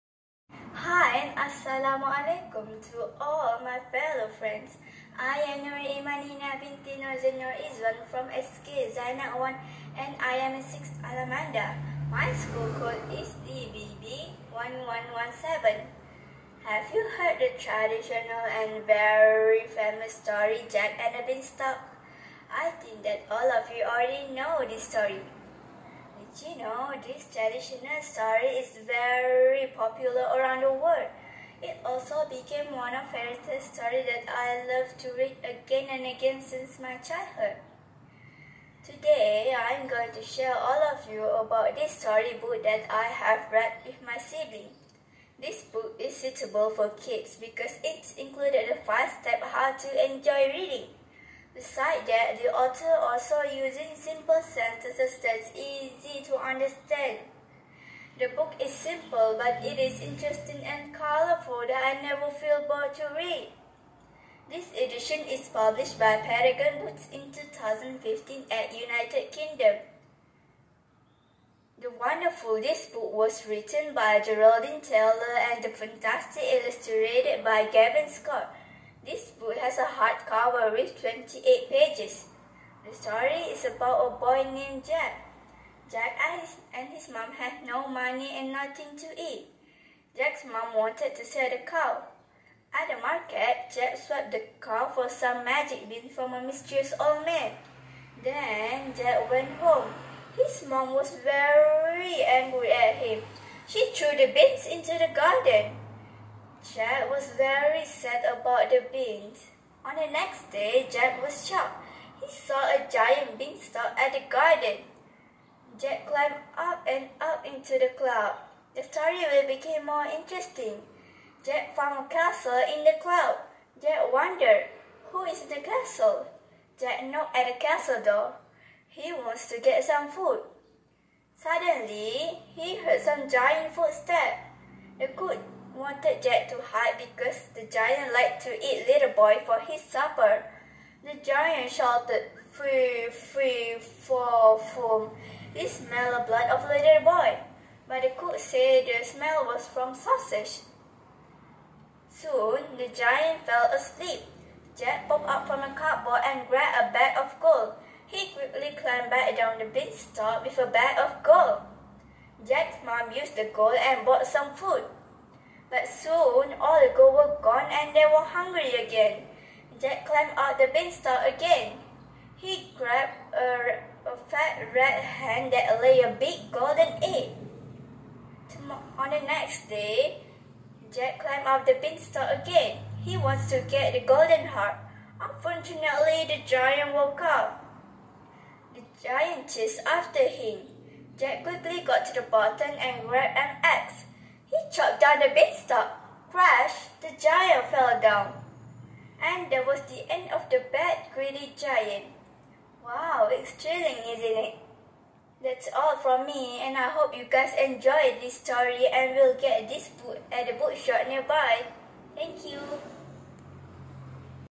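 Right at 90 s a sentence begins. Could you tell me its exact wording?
Jack's mom wanted to sell the cow.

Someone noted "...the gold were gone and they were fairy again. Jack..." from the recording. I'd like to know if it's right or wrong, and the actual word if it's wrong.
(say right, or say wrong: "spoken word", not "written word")
wrong: "hungry", not "fairy".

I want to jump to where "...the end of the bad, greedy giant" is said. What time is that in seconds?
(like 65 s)
199 s.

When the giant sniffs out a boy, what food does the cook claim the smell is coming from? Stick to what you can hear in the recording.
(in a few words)
Sausage.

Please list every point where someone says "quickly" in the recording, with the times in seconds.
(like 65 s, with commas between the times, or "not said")
158 s, 191 s.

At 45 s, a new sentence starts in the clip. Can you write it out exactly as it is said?
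This book is suitable for kids because it included the five-step how to enjoy reading.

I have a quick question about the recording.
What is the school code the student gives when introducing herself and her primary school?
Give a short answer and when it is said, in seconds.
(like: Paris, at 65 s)
DBB 1117, at 13 s.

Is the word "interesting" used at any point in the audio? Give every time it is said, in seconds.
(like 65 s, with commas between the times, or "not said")
60 s, 120 s.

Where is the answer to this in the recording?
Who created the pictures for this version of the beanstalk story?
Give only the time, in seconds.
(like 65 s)
77 s.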